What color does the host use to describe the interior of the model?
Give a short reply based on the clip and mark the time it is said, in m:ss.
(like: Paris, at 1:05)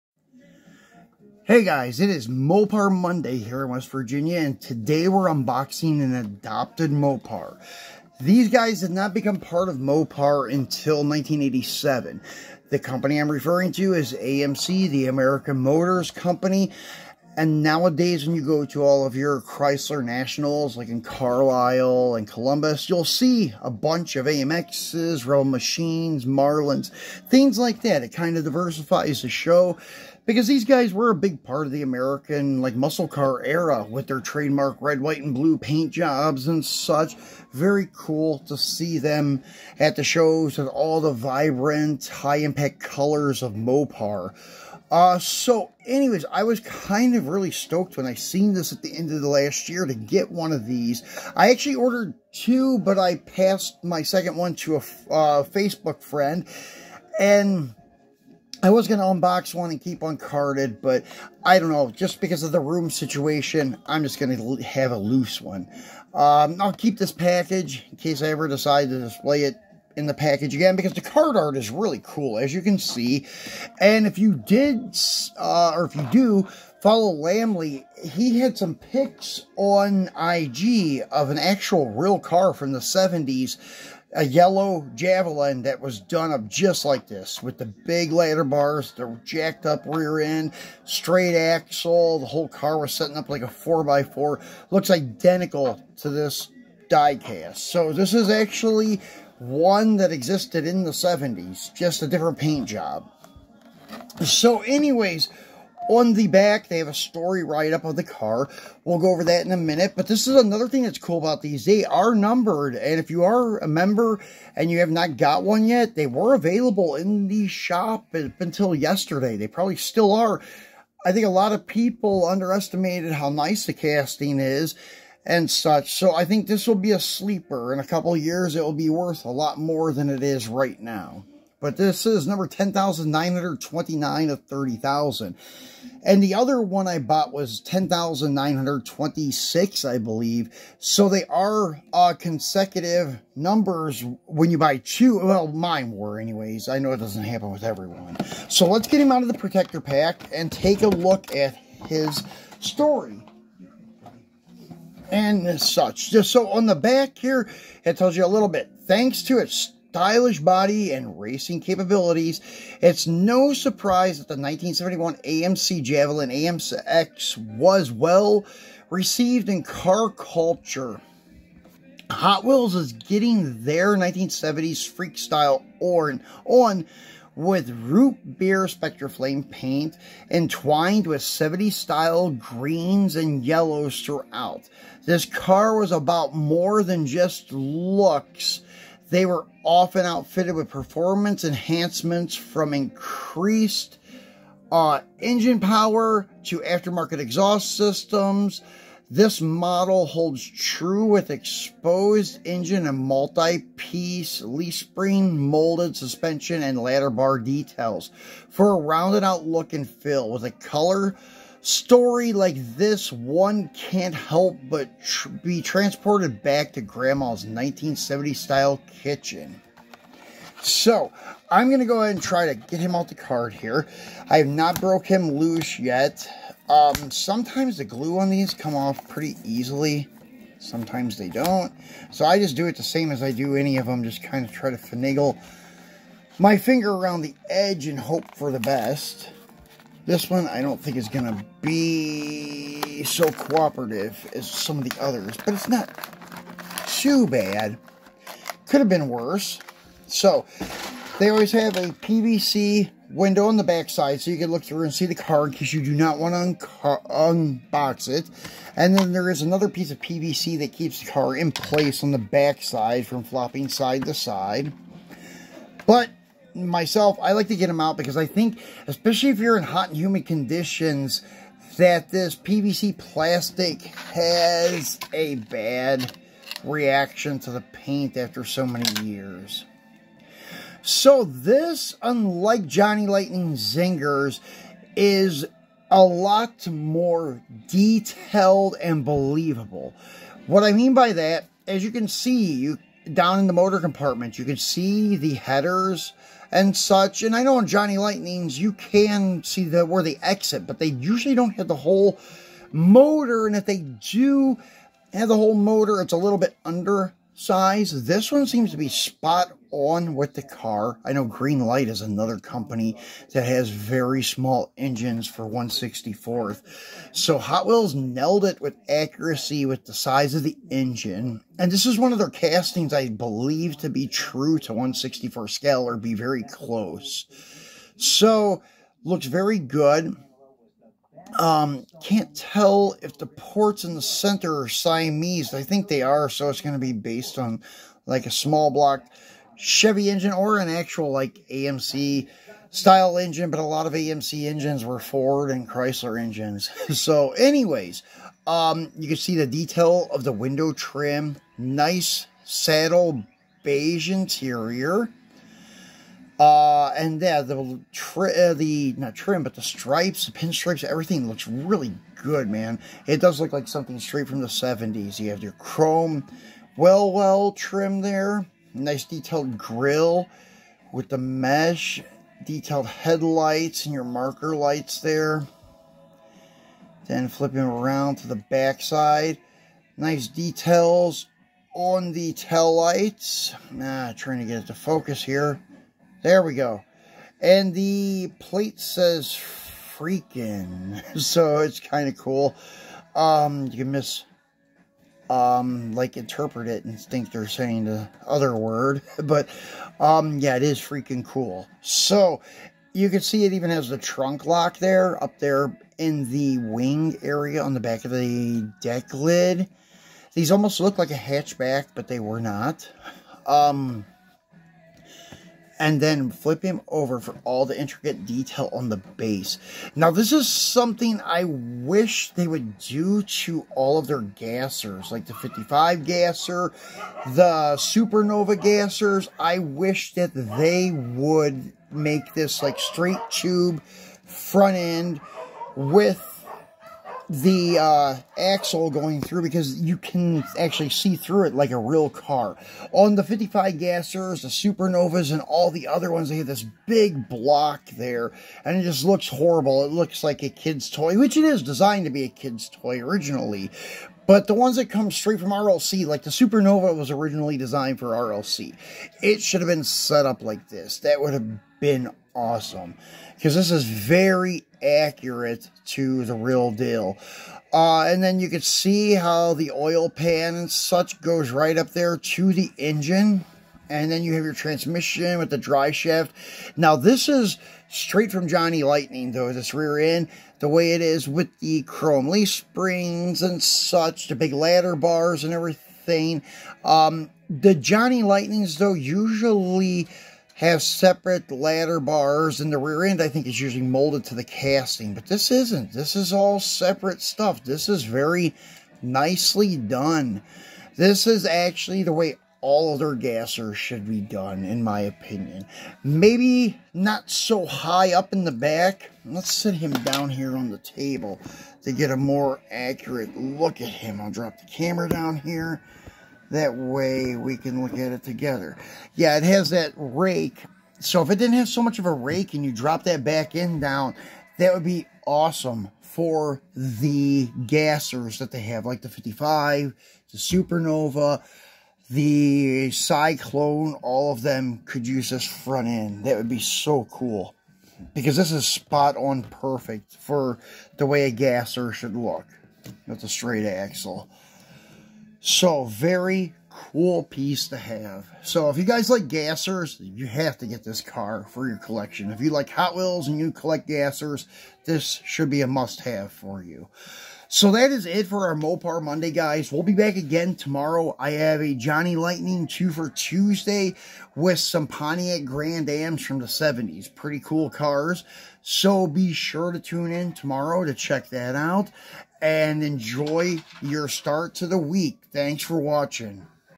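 Saddle beige, at 5:52.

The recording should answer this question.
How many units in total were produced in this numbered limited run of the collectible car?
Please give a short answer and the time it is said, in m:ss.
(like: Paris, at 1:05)
30,000, at 2:14.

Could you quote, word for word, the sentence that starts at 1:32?
The whole car was setting up like a 4x4.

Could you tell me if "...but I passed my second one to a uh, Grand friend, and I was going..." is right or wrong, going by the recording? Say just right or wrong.
wrong.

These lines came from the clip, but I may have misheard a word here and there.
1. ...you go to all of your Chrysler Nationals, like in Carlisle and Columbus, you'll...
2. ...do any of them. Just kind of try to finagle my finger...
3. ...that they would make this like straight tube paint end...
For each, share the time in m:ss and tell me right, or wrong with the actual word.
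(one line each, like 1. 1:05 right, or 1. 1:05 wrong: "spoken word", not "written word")
1. 0:18 right
2. 3:53 right
3. 7:10 wrong: "front", not "paint".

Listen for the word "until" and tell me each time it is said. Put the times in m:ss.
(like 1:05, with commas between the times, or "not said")
0:10, 1:58.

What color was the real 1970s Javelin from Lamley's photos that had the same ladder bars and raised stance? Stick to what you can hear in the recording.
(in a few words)
Yellow.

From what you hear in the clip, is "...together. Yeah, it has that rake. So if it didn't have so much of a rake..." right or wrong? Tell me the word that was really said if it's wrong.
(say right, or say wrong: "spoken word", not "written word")
right.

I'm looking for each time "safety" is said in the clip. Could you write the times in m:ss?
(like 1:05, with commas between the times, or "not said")
not said.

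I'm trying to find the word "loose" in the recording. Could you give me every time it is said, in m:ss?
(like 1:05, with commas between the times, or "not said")
1:04, 3:45.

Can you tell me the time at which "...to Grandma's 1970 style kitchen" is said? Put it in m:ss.
3:36.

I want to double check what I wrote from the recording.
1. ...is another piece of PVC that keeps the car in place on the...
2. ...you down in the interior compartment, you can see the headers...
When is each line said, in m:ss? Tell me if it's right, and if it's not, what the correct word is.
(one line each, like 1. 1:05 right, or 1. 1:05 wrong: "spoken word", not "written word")
1. 4:19 right
2. 4:52 wrong: "motor", not "interior".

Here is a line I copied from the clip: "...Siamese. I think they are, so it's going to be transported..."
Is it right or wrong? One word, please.
wrong.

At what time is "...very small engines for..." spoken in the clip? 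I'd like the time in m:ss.
5:13.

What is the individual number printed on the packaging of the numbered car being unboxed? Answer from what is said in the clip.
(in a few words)
10,929.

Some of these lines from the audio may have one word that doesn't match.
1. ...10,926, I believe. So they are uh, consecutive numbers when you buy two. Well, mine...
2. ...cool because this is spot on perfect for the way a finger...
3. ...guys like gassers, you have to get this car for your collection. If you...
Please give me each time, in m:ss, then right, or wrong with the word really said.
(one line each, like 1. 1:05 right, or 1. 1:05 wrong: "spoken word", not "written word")
1. 2:17 right
2. 8:57 wrong: "gasser", not "finger"
3. 9:08 right.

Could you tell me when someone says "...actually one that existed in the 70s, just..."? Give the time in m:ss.
1:38.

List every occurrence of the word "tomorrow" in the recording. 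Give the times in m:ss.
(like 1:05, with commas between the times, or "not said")
9:20, 9:30.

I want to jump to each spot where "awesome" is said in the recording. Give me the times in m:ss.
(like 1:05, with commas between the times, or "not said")
7:42, 8:45.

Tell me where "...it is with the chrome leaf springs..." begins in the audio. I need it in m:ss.
8:00.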